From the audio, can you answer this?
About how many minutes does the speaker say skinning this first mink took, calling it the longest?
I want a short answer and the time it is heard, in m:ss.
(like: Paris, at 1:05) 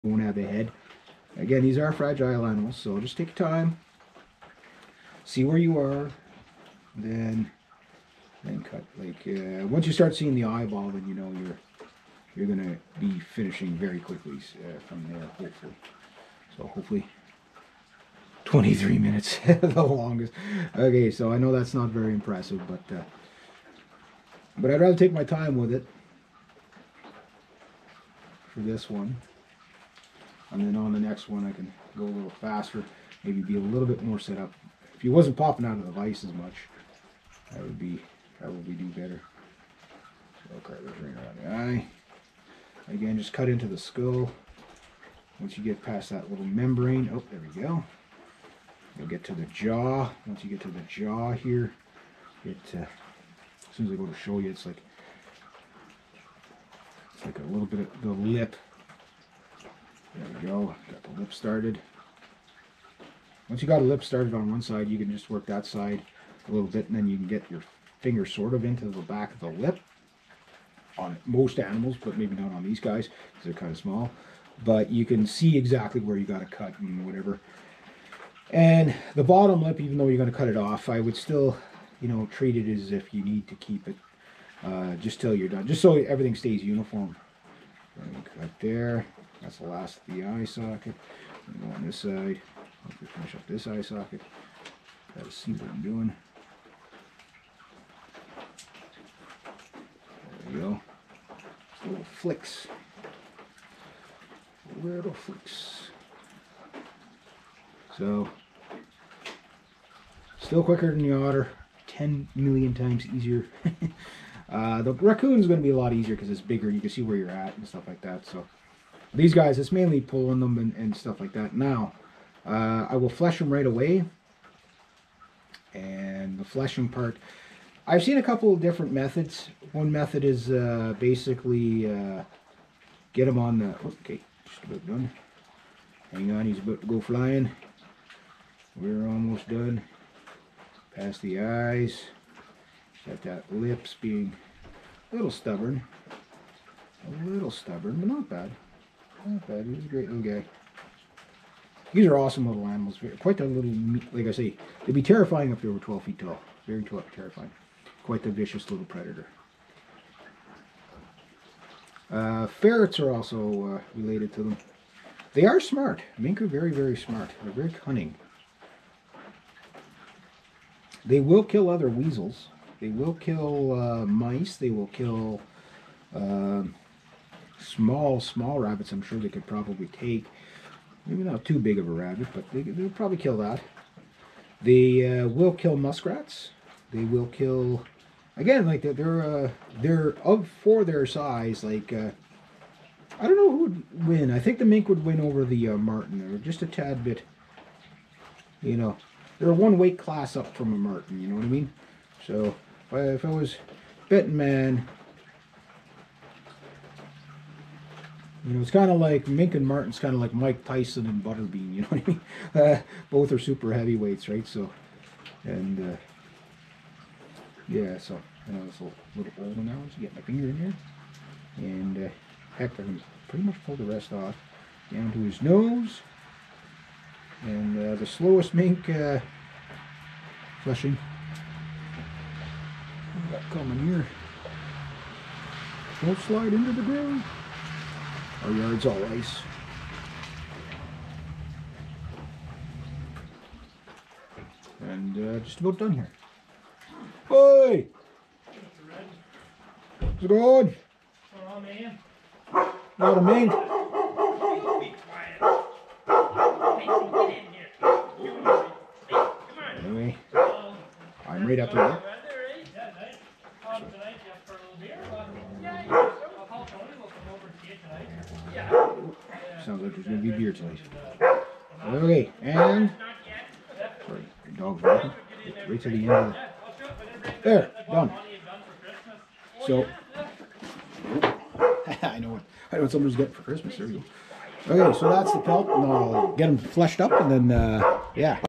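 23, at 0:18.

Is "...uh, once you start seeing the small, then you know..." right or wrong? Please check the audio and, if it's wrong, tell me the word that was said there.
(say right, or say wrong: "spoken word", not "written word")
wrong: "eyeball", not "small".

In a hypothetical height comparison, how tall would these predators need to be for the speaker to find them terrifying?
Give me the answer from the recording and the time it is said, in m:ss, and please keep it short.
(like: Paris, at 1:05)
12 feet, at 2:35.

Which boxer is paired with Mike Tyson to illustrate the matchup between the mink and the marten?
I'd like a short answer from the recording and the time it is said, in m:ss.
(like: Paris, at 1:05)
Butterbean, at 3:31.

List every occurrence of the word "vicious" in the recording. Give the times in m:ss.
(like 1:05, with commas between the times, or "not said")
2:38.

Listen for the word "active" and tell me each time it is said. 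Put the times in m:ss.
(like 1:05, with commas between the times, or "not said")
not said.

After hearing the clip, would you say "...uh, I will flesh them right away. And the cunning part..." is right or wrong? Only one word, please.
wrong.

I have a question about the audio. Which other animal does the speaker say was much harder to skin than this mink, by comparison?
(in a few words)
otter.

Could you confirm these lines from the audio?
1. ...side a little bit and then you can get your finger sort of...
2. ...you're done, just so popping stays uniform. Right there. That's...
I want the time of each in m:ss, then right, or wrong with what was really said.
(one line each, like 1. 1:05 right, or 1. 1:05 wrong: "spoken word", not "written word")
1. 1:05 right
2. 1:25 wrong: "everything", not "popping".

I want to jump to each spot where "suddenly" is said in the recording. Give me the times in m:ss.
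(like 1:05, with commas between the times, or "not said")
not said.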